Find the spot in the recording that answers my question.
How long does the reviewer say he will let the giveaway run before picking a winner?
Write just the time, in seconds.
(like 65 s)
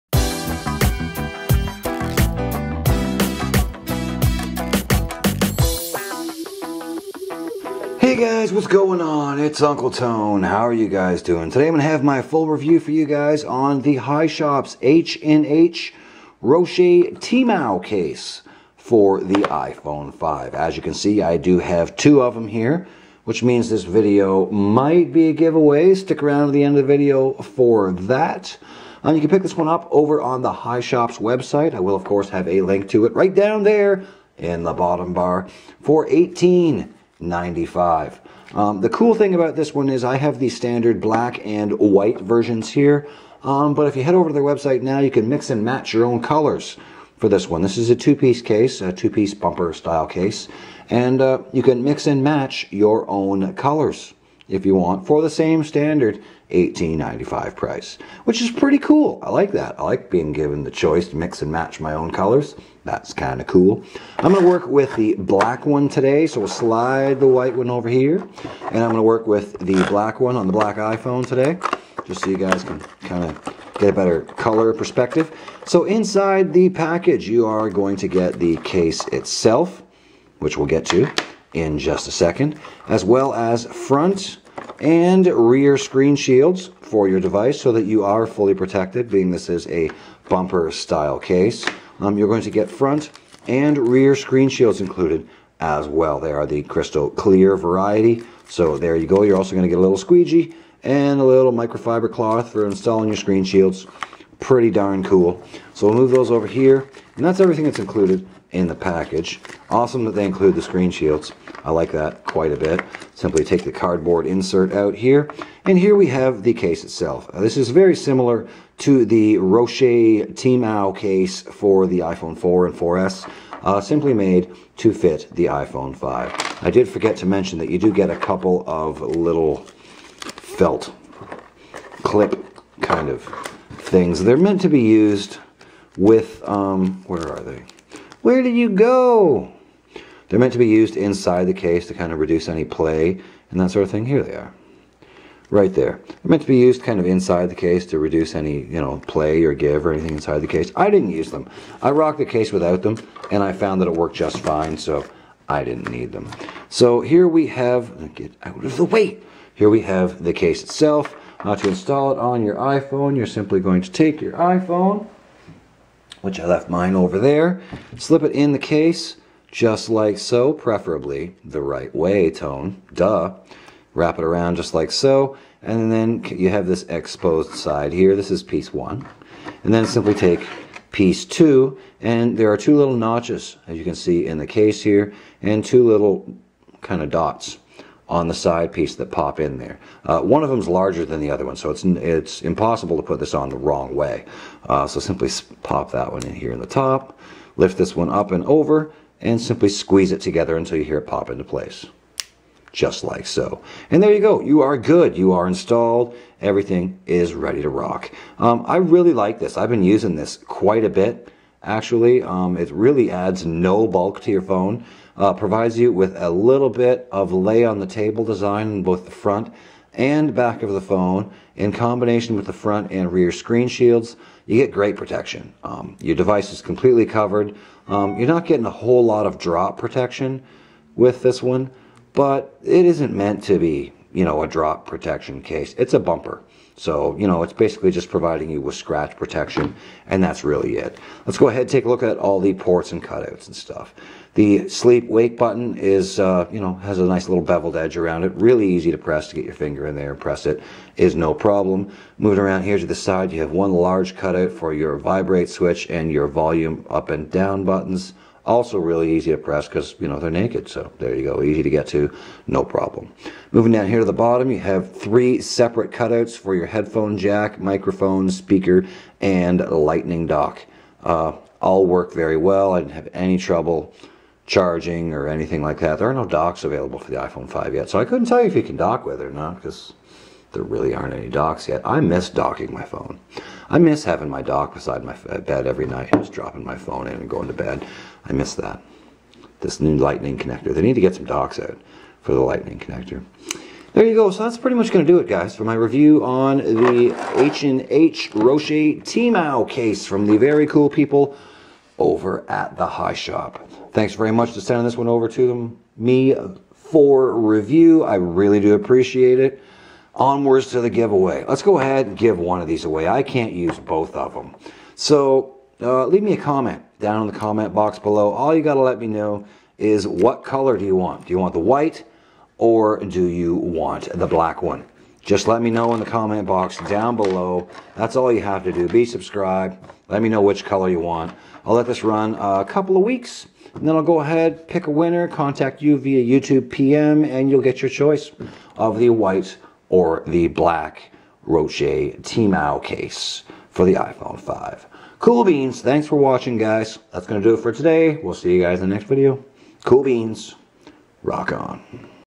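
332 s.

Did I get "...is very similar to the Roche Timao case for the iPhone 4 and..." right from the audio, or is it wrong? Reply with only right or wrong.
right.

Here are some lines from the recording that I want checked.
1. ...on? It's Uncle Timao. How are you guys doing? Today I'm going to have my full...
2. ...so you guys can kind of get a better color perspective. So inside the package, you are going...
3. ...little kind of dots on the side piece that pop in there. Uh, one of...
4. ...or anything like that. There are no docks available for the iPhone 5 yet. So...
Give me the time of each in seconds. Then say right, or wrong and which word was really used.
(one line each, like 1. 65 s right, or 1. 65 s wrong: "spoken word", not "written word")
1. 9 s wrong: "Tone", not "Timao"
2. 72 s right
3. 185 s right
4. 275 s right.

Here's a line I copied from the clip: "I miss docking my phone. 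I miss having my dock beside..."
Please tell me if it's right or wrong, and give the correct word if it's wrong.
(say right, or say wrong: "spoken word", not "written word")
right.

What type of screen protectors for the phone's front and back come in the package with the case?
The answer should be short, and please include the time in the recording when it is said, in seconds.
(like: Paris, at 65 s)
crystal clear, at 96 s.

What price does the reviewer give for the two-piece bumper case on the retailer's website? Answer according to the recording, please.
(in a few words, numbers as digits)
$18.95.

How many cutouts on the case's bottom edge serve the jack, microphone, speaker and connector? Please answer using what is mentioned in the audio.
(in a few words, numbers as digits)
3.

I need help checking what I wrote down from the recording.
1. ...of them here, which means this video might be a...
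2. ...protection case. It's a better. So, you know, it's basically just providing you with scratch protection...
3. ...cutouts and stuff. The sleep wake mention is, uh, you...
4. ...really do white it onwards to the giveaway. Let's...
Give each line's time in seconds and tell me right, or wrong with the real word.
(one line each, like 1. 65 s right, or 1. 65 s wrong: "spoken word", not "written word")
1. 22 s right
2. 234 s wrong: "bumper", not "better"
3. 243 s wrong: "button", not "mention"
4. 308 s wrong: "appreciate", not "white".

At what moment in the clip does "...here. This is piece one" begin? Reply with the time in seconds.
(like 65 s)
177 s.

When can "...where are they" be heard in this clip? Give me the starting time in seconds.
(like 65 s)
137 s.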